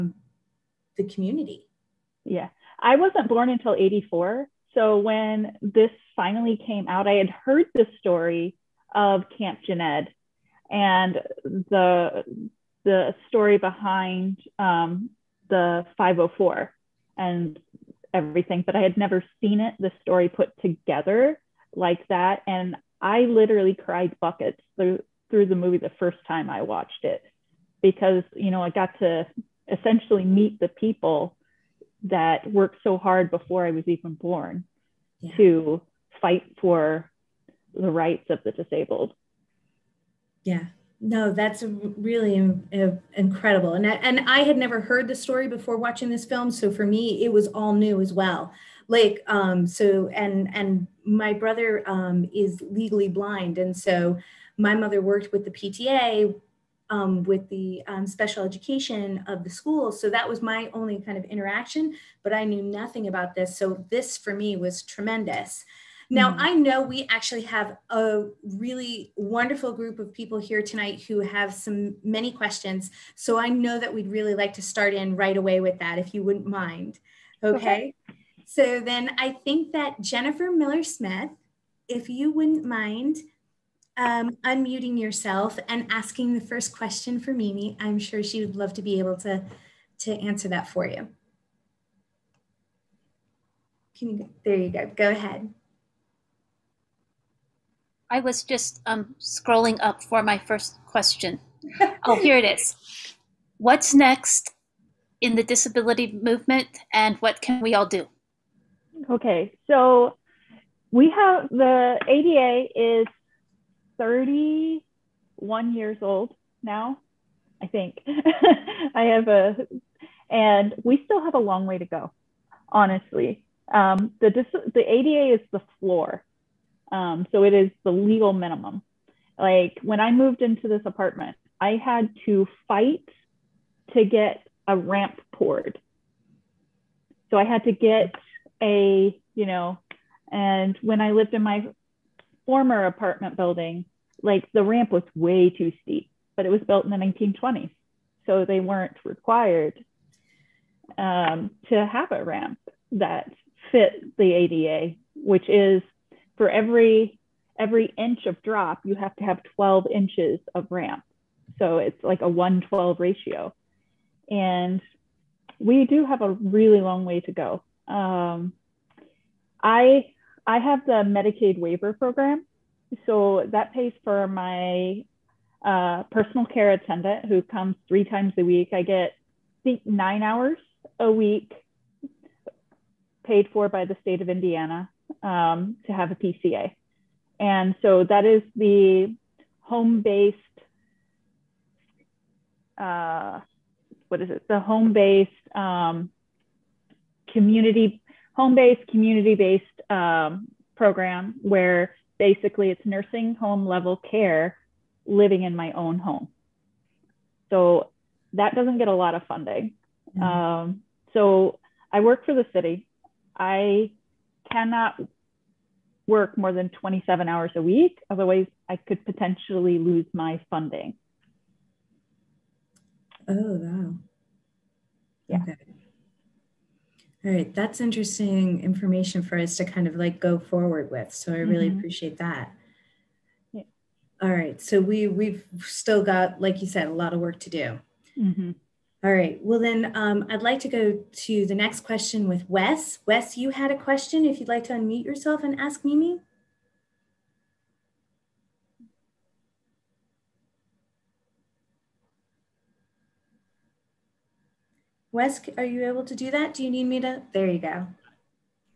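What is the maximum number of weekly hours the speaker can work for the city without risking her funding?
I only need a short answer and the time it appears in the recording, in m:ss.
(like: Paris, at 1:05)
27, at 3:36.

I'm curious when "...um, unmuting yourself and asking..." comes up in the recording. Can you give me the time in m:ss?
1:23.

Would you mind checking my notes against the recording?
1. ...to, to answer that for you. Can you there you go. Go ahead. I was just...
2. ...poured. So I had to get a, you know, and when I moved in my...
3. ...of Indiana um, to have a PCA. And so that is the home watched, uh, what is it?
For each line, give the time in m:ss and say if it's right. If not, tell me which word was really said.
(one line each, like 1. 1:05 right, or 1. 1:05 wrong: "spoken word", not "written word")
1. 1:29 right
2. 2:15 wrong: "lived", not "moved"
3. 3:04 wrong: "based", not "watched".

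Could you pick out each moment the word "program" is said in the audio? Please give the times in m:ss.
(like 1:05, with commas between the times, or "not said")
2:51, 3:20.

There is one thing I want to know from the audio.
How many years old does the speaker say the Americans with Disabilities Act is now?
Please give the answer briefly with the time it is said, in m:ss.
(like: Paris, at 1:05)
31, at 1:54.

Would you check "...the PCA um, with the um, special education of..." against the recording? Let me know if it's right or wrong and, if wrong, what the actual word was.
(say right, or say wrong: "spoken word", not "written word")
wrong: "PTA", not "PCA".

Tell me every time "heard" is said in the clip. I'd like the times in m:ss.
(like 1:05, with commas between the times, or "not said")
0:07, 0:44.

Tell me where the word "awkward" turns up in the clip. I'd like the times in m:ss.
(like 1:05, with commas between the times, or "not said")
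not said.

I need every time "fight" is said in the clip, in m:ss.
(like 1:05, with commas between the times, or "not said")
0:36, 2:12.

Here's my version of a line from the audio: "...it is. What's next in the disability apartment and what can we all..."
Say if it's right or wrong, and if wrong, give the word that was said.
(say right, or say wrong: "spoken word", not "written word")
wrong: "movement", not "apartment".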